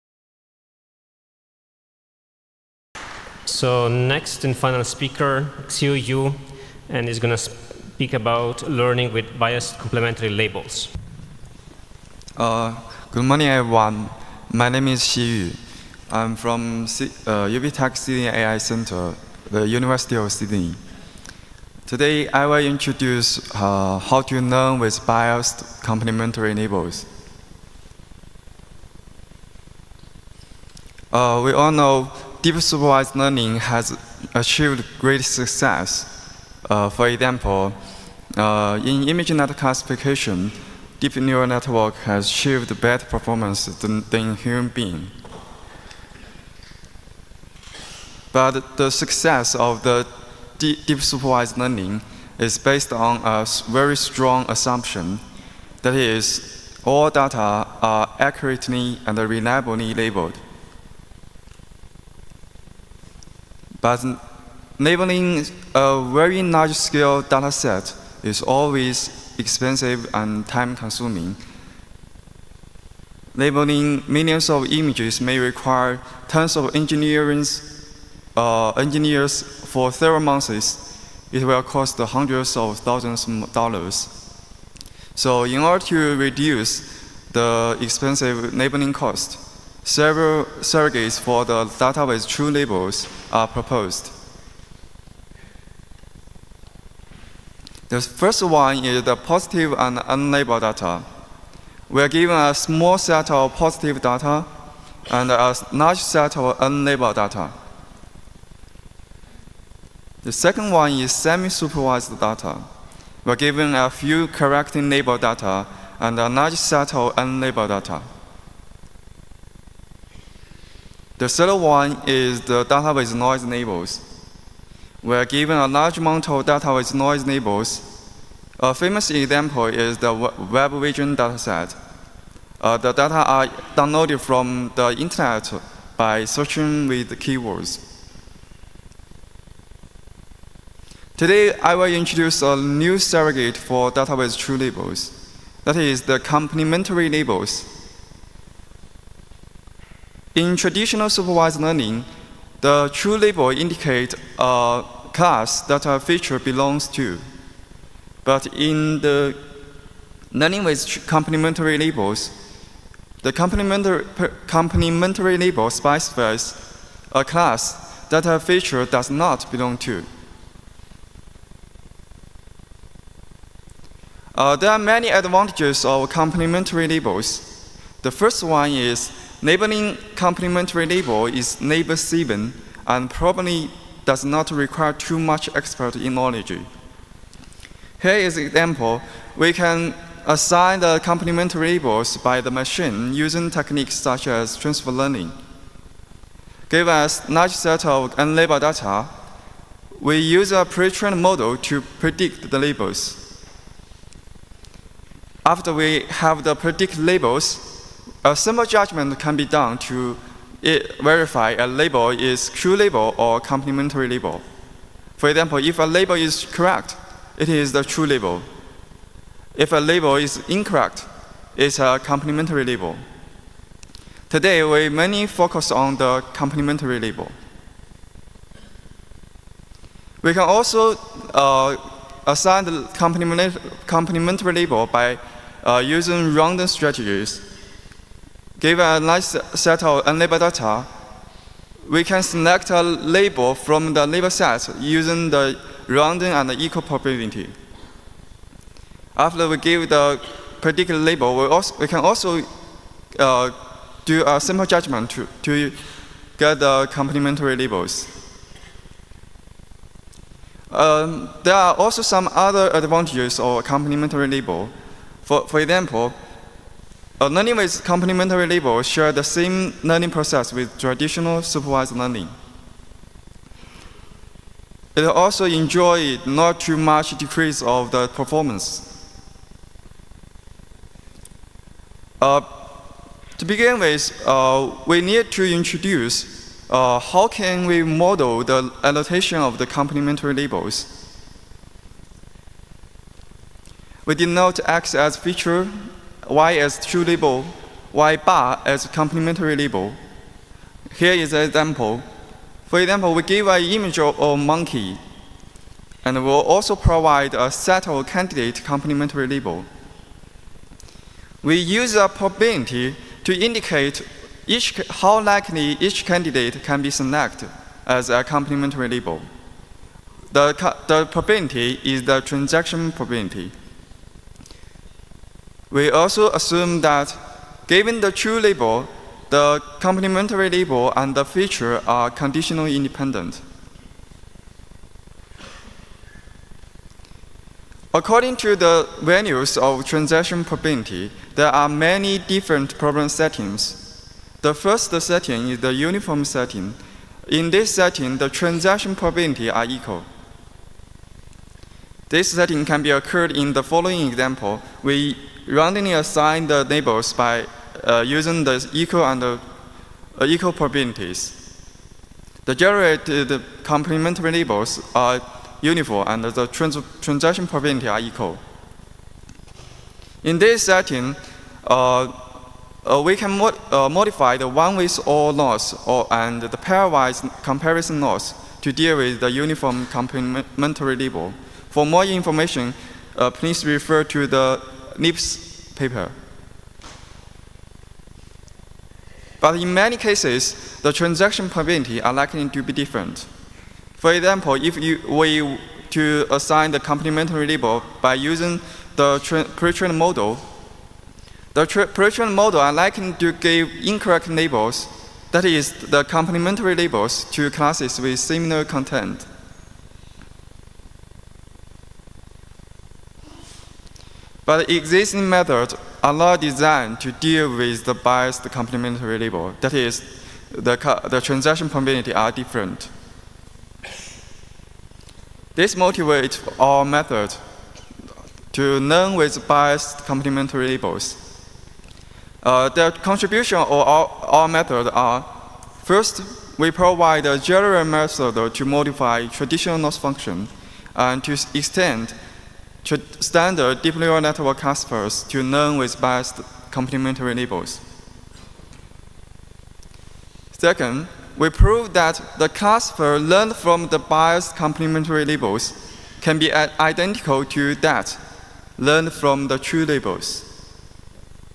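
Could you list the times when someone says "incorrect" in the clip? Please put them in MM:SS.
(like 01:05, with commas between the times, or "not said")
03:40, 06:43.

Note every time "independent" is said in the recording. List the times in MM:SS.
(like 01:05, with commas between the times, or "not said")
05:32.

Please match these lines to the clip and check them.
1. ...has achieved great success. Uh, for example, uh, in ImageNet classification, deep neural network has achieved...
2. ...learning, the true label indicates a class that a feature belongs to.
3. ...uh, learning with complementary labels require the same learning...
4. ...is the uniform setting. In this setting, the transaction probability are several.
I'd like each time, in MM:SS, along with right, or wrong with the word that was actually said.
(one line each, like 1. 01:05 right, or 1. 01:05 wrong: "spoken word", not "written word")
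1. 00:33 right
2. 02:31 right
3. 04:27 wrong: "share", not "require"
4. 05:45 wrong: "equal", not "several".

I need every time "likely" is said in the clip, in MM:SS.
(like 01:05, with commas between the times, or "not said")
05:15, 06:32, 06:42.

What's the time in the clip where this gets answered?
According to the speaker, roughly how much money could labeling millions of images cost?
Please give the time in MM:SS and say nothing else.
01:21.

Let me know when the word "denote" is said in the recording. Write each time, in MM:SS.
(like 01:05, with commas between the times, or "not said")
04:54.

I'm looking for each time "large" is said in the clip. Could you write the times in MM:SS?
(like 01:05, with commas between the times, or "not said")
01:06, 01:45, 01:56, 02:05, 03:17.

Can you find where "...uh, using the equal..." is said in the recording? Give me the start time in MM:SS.
05:57.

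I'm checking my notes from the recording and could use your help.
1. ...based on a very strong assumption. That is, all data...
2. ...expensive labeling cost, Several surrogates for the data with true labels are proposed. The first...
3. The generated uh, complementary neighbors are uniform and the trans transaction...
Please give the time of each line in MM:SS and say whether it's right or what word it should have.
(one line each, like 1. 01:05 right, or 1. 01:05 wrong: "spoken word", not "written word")
1. 00:52 right
2. 01:27 right
3. 06:02 right.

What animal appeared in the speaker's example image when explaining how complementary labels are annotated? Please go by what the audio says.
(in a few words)
monkey.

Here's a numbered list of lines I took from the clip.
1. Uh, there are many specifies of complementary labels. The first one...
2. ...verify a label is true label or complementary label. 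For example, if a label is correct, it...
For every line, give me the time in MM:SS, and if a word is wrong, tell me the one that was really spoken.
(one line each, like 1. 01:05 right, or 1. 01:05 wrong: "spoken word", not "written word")
1. 02:54 wrong: "advantages", not "specifies"
2. 03:31 right.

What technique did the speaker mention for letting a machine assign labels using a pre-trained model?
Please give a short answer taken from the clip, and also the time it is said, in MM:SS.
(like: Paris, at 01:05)
transfer learning, at 03:14.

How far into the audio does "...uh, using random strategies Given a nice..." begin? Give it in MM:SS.
03:55.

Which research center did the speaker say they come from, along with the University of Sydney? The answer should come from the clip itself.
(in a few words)
UBTech Sydney AI Center.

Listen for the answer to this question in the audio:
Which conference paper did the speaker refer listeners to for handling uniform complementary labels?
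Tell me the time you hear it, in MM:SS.
06:24.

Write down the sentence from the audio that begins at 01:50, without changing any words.
The second one is semi-supervised data.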